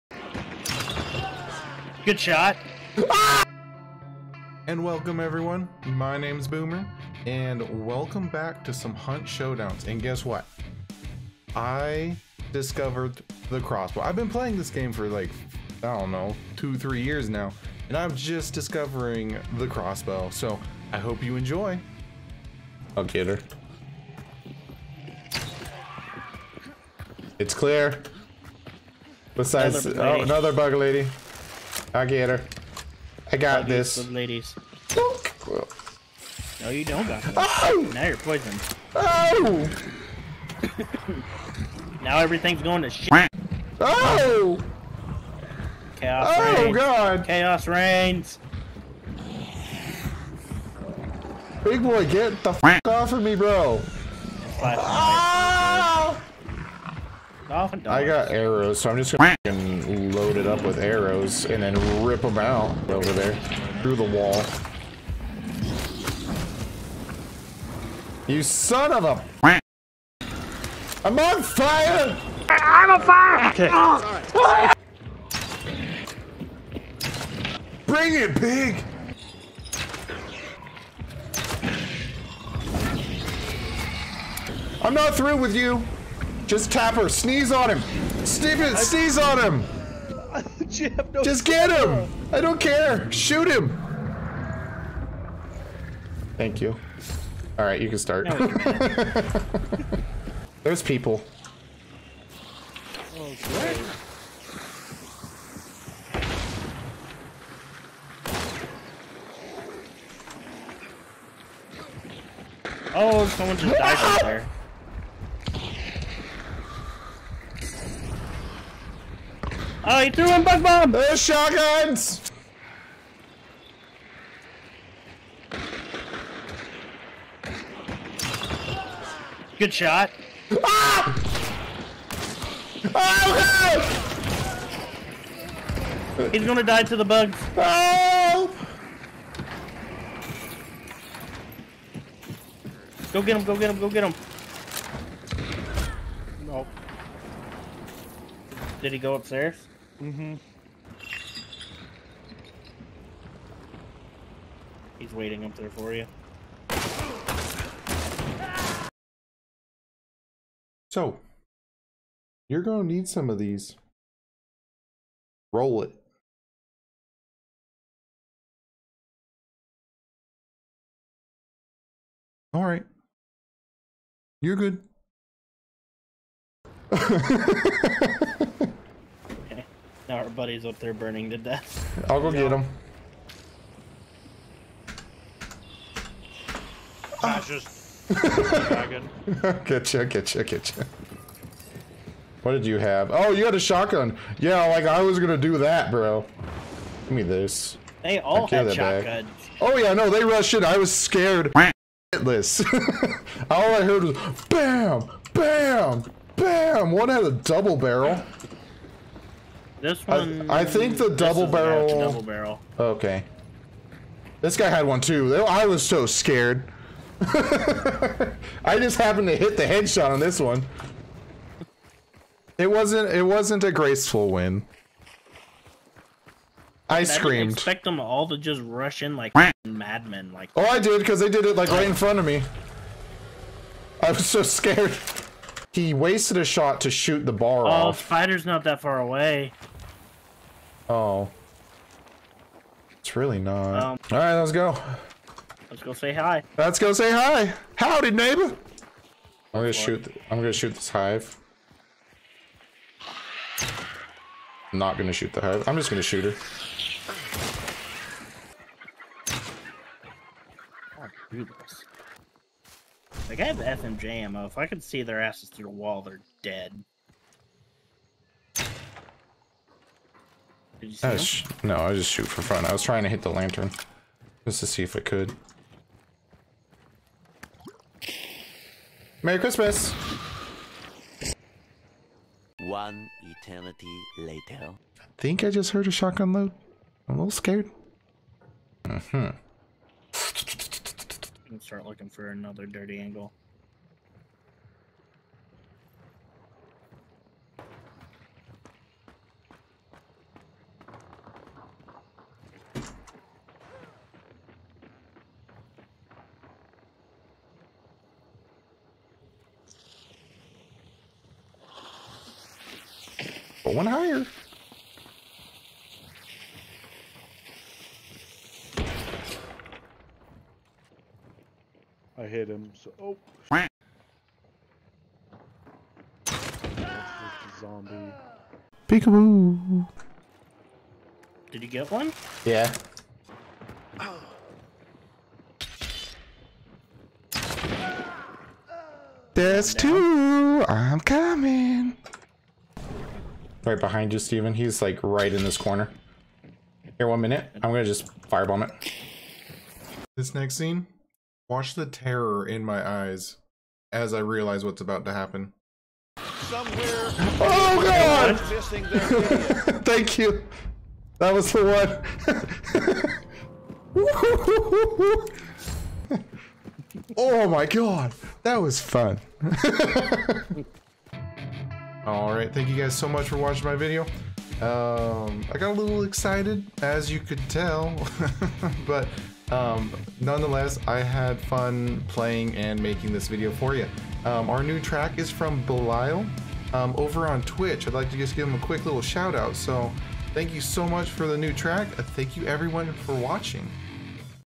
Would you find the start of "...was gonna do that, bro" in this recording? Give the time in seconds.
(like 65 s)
195 s.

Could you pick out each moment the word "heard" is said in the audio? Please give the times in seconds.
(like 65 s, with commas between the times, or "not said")
203 s, 285 s.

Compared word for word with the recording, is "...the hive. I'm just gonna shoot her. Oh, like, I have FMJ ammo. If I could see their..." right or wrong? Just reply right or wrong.
right.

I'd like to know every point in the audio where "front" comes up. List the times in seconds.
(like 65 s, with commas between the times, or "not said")
231 s.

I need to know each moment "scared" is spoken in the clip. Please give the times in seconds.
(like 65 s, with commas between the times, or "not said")
200 s, 216 s, 234 s, 287 s.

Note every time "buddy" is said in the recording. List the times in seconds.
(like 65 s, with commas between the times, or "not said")
180 s.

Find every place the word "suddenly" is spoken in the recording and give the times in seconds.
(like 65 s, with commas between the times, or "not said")
not said.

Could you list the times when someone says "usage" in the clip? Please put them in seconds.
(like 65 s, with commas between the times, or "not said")
not said.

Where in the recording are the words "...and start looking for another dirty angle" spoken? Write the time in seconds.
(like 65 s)
291 s.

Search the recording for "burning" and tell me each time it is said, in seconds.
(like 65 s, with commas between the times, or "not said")
180 s.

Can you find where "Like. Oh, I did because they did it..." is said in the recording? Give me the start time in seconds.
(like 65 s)
230 s.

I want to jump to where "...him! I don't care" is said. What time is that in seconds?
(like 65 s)
91 s.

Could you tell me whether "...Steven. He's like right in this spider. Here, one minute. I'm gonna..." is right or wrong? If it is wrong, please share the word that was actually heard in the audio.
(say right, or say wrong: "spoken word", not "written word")
wrong: "corner", not "spider".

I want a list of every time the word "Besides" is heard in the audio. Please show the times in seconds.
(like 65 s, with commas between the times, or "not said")
29 s.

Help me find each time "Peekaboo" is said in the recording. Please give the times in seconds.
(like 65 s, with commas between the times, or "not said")
328 s.